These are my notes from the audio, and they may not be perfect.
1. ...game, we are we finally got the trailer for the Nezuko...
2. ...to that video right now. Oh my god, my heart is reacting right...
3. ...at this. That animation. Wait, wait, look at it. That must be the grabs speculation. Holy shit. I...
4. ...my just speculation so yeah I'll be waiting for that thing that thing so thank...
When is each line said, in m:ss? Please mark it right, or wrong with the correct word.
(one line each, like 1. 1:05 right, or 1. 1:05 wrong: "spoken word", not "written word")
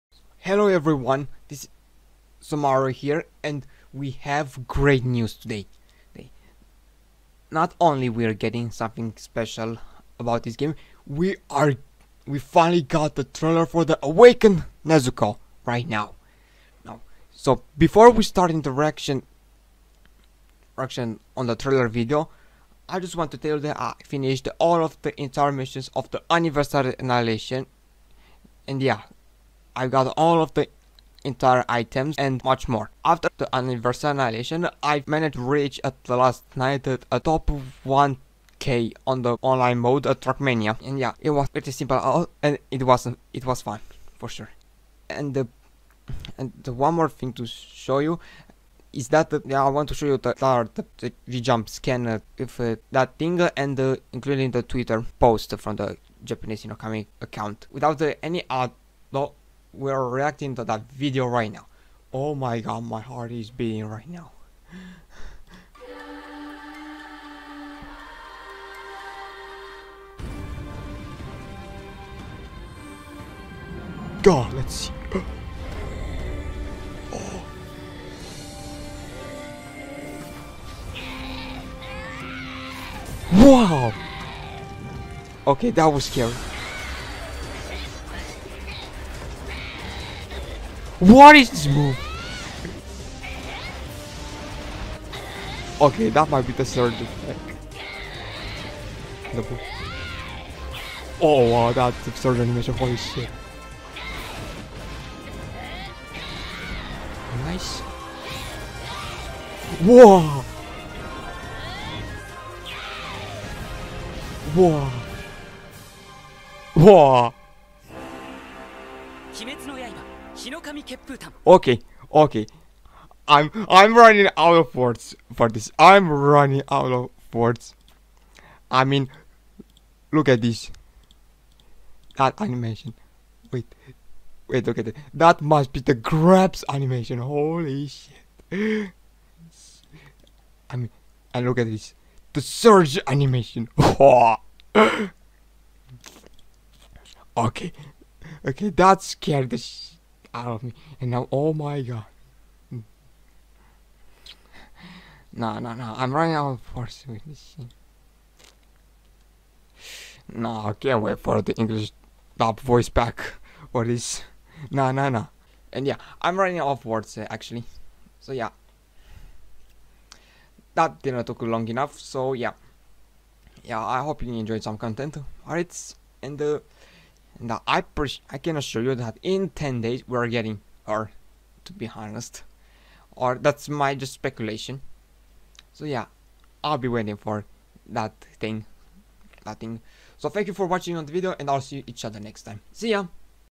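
1. 0:10 wrong: "Awakened", not "Nezuko"
2. 1:00 wrong: "beating", not "reacting"
3. 2:10 wrong: "animation", not "speculation"
4. 3:03 right.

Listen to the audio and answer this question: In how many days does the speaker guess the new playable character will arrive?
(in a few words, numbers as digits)
10.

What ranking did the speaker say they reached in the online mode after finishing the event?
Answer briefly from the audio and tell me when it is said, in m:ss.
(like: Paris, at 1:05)
top 1K, at 0:37.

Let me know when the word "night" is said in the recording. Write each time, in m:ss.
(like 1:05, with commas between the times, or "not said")
0:36.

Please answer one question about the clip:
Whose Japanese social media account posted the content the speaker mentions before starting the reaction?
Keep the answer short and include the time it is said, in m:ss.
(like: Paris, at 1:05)
Hinokami, at 0:56.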